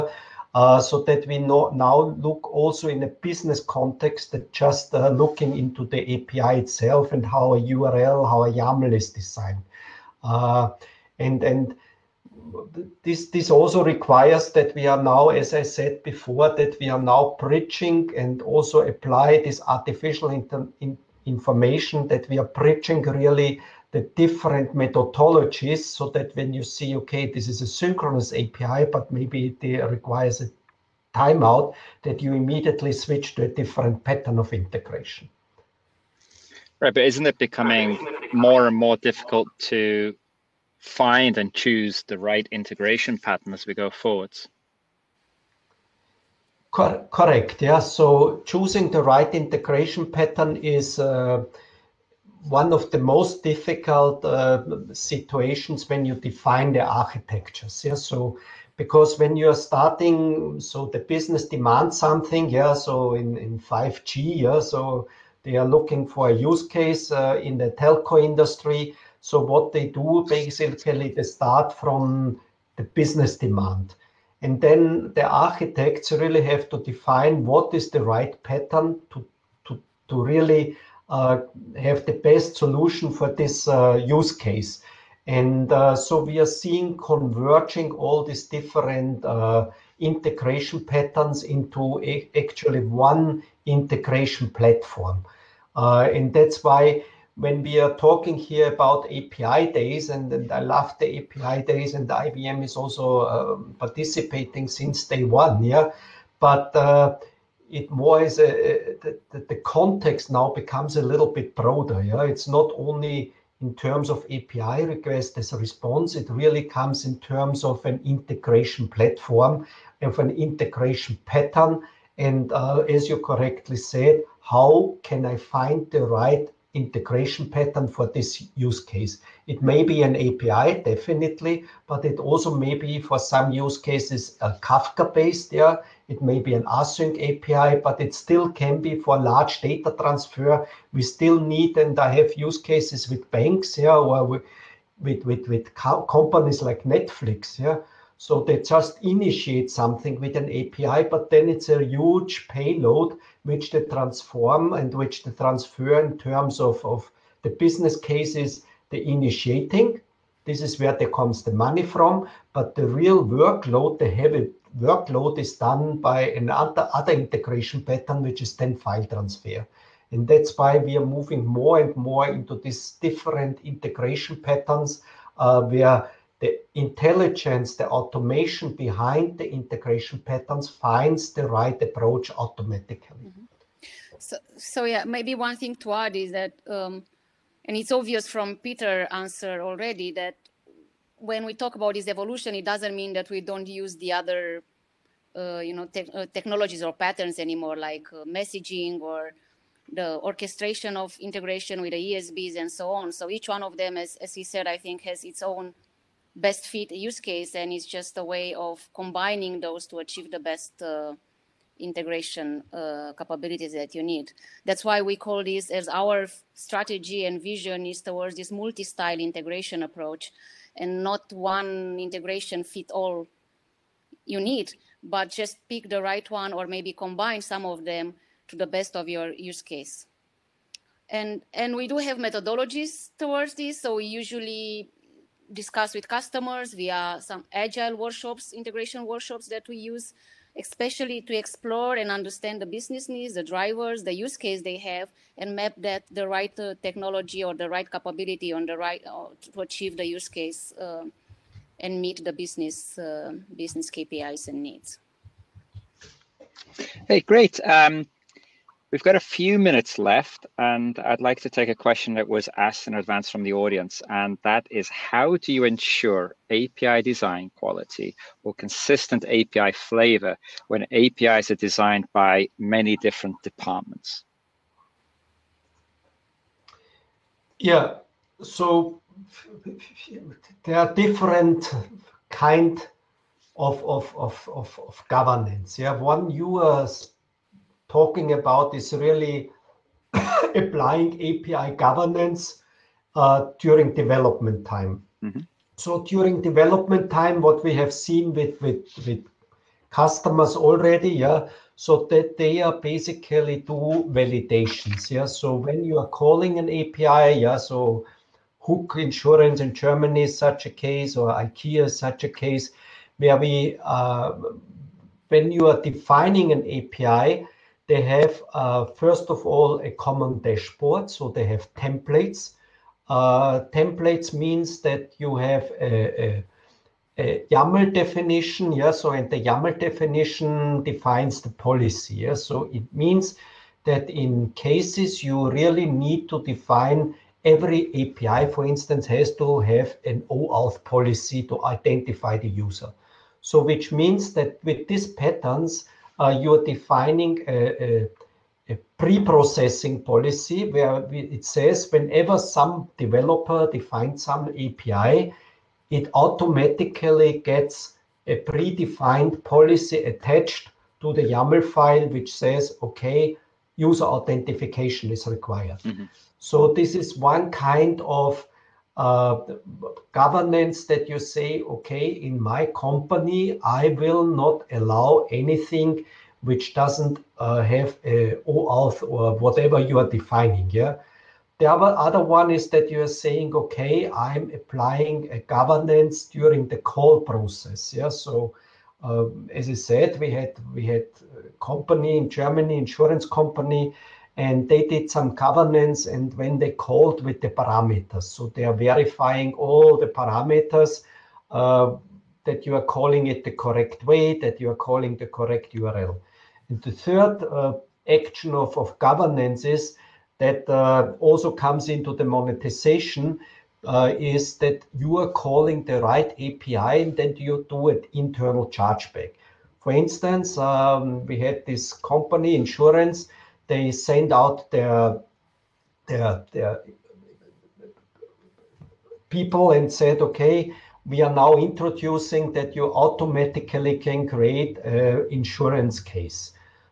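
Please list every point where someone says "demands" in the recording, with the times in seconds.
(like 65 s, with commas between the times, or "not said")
61 s, 73 s.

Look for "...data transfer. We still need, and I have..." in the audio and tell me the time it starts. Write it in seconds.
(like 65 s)
139 s.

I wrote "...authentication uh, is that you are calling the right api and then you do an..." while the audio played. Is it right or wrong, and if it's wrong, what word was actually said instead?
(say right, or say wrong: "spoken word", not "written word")
wrong: "monetization", not "authentication".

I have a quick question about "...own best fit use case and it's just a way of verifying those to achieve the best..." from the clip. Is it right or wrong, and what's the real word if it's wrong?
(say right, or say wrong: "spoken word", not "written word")
wrong: "combining", not "verifying".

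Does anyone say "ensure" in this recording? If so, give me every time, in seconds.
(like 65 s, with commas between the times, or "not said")
265 s.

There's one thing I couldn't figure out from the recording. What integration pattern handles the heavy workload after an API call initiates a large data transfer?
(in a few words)
file transfer.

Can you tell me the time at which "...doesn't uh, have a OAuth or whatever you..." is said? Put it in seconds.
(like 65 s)
376 s.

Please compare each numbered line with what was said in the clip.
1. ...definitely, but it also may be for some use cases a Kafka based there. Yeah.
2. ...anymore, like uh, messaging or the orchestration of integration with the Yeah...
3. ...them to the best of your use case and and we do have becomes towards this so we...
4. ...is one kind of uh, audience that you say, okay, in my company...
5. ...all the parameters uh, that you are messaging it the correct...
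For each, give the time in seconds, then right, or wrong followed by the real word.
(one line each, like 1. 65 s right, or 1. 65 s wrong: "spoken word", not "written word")
1. 130 s right
2. 197 s wrong: "ESBs", not "Yeah"
3. 227 s wrong: "methodologies", not "becomes"
4. 366 s wrong: "governance", not "audience"
5. 399 s wrong: "calling", not "messaging".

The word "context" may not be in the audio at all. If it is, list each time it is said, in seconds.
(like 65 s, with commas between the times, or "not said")
3 s, 109 s.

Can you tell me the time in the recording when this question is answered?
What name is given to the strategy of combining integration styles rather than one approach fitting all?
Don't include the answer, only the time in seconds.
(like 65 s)
218 s.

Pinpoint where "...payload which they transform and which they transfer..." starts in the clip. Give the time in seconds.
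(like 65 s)
152 s.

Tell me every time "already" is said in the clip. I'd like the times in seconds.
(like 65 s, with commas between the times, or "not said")
189 s, 300 s.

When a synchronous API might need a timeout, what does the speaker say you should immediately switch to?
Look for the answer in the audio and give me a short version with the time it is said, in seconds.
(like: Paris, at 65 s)
a different pattern of integration, at 33 s.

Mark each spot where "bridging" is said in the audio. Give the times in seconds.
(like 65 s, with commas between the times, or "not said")
17 s, 22 s.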